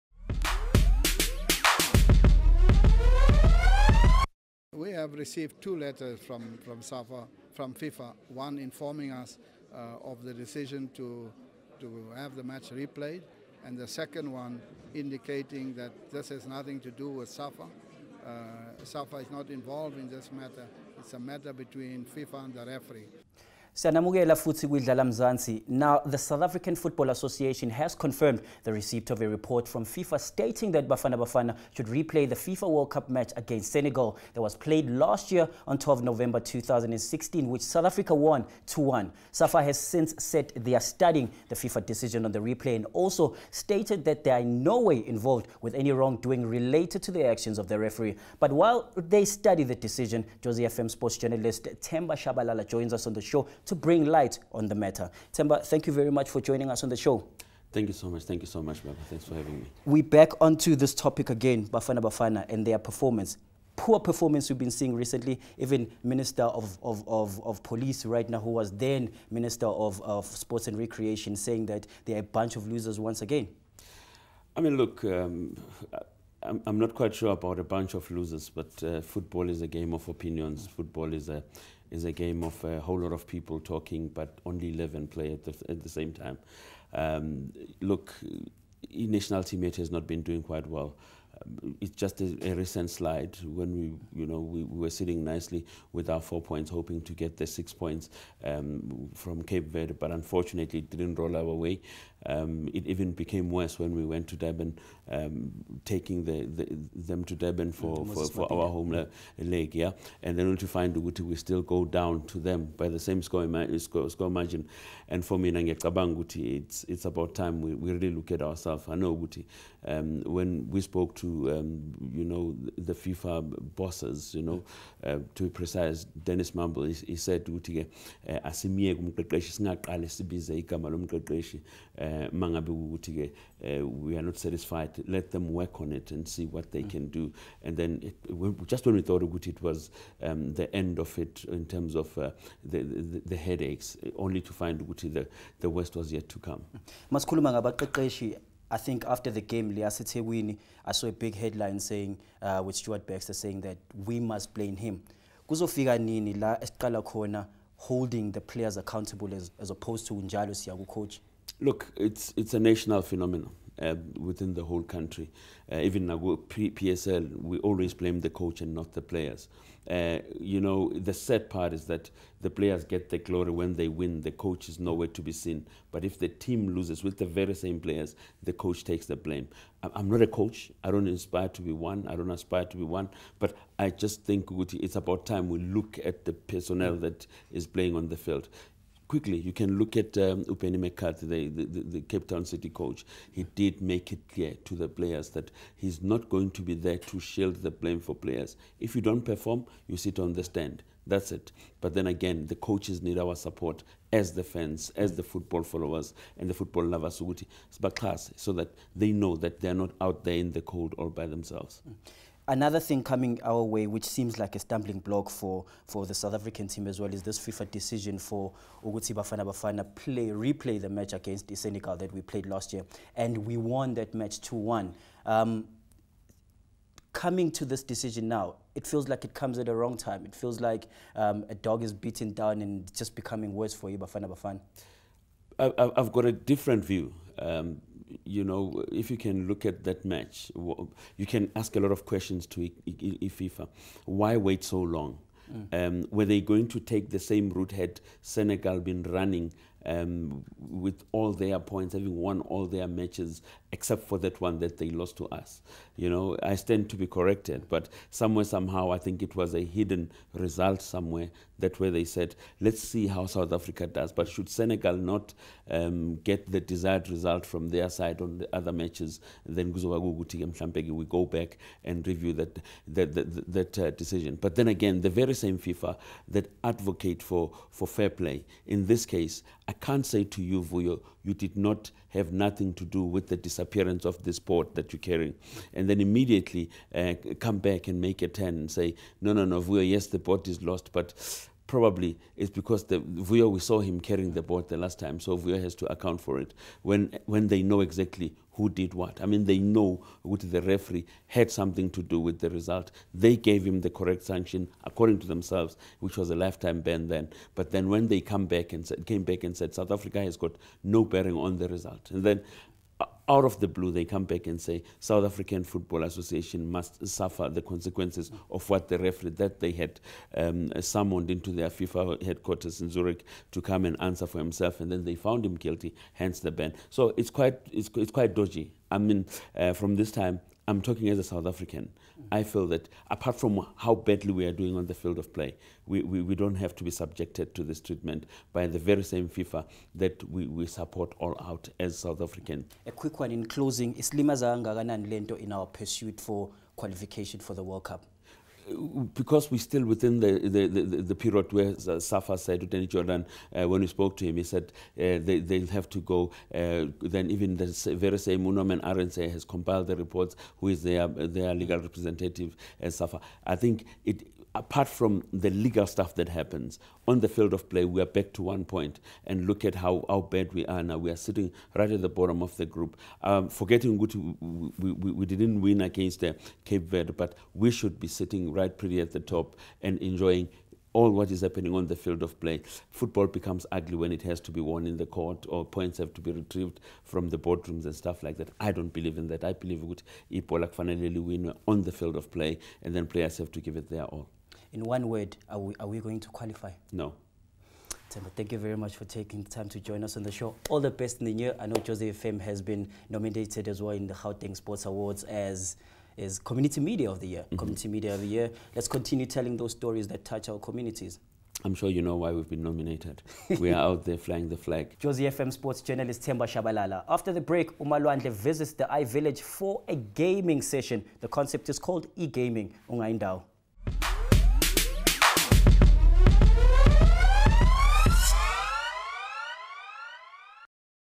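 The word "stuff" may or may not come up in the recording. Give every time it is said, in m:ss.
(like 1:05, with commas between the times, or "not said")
6:05, 6:27.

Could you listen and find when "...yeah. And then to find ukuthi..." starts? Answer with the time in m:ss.
1:49.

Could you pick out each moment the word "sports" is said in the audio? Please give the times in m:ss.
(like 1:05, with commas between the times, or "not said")
0:50, 1:10, 6:44, 6:55.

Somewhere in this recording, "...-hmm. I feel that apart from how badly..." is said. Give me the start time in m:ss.
5:32.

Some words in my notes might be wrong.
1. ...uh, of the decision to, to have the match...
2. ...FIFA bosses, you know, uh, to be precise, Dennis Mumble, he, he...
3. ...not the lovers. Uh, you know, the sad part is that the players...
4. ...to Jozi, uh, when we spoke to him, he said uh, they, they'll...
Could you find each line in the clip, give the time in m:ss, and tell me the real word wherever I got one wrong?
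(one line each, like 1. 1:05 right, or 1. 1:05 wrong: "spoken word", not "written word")
1. 0:09 right
2. 2:02 right
3. 2:48 wrong: "players", not "lovers"
4. 5:52 wrong: "Jordan", not "Jozi".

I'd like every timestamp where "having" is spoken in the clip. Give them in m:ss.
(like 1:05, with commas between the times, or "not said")
0:59, 4:11.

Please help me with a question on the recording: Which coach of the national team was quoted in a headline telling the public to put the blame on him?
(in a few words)
Stuart Baxter.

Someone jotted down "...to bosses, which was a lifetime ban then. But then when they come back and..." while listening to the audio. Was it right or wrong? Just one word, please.
wrong.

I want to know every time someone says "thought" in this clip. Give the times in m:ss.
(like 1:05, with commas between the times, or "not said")
2:19.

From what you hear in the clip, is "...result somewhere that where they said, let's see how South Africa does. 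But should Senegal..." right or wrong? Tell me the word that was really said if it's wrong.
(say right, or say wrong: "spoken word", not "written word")
right.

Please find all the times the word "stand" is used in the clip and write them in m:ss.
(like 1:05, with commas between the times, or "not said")
3:20, 4:16.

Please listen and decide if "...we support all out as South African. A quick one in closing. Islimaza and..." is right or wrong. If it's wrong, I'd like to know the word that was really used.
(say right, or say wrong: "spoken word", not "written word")
right.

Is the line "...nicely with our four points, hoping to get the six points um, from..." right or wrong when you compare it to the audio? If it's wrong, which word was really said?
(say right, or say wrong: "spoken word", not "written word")
right.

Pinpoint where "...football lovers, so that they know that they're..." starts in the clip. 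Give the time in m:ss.
3:26.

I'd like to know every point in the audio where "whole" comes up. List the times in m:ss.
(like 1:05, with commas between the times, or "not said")
1:22, 2:44.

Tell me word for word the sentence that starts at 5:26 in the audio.
So it's quite it's, it's quite dodgy.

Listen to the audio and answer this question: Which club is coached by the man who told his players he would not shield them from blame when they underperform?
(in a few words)
Cape Town City.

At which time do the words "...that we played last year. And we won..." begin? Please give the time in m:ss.
3:41.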